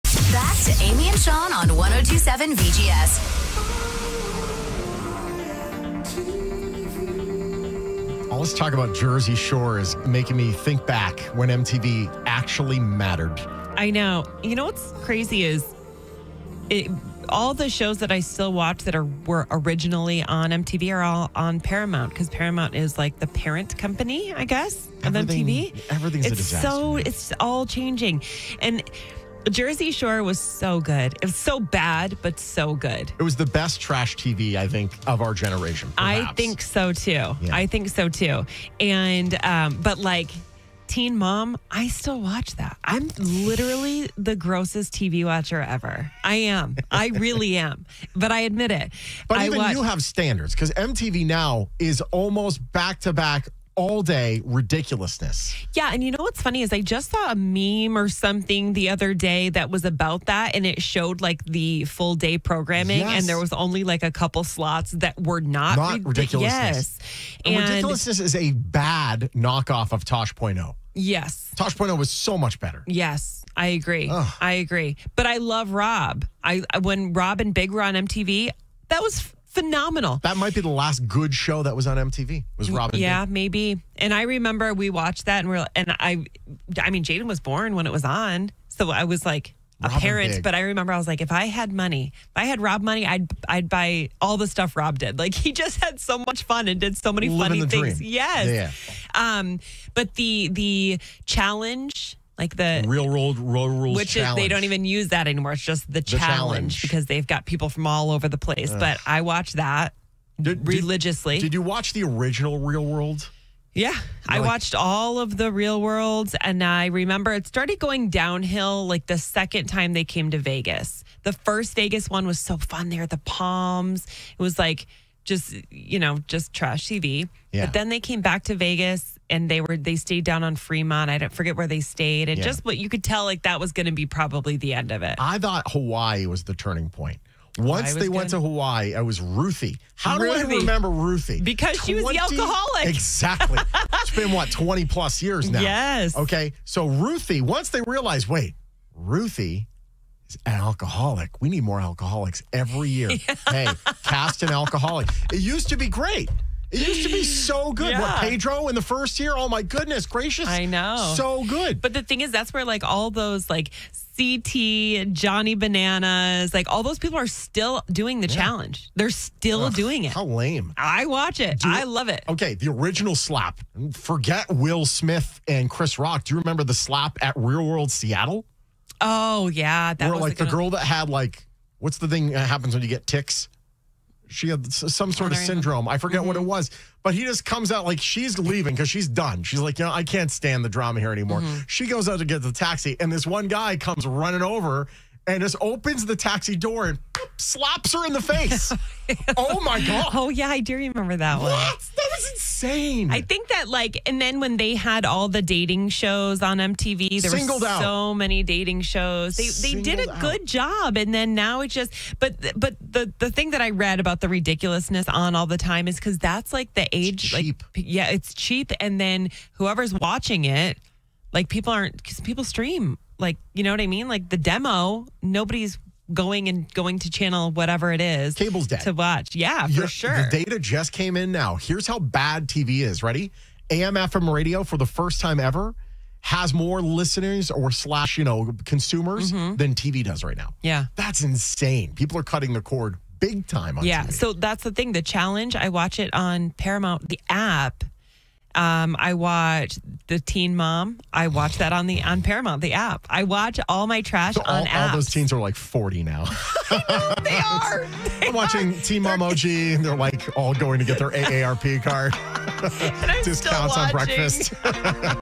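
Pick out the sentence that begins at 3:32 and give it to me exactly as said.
But but the the thing that I read about the ridiculousness on all the time is because that's like the age.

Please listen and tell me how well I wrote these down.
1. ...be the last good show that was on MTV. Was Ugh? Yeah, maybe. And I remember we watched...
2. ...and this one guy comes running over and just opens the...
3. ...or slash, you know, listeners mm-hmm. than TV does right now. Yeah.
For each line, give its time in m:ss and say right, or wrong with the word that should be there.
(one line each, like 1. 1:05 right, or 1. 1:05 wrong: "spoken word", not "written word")
1. 1:20 wrong: "Robin", not "Ugh"
2. 3:13 right
3. 3:57 wrong: "consumers", not "listeners".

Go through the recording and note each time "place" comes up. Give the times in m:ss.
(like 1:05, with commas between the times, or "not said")
1:48.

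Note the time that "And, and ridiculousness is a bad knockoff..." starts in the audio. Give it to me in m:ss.
1:07.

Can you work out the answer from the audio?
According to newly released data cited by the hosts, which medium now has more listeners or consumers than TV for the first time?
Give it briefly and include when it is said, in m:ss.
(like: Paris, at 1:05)
AM FM radio, at 3:53.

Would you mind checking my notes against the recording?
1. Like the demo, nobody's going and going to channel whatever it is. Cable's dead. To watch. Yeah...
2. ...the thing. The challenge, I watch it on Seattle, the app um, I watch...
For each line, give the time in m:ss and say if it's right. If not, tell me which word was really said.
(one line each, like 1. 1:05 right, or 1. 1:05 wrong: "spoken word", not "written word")
1. 3:44 right
2. 4:04 wrong: "Paramount", not "Seattle".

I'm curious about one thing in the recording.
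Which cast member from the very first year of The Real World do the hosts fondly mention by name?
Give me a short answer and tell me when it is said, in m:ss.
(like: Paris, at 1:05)
Pedro, at 2:38.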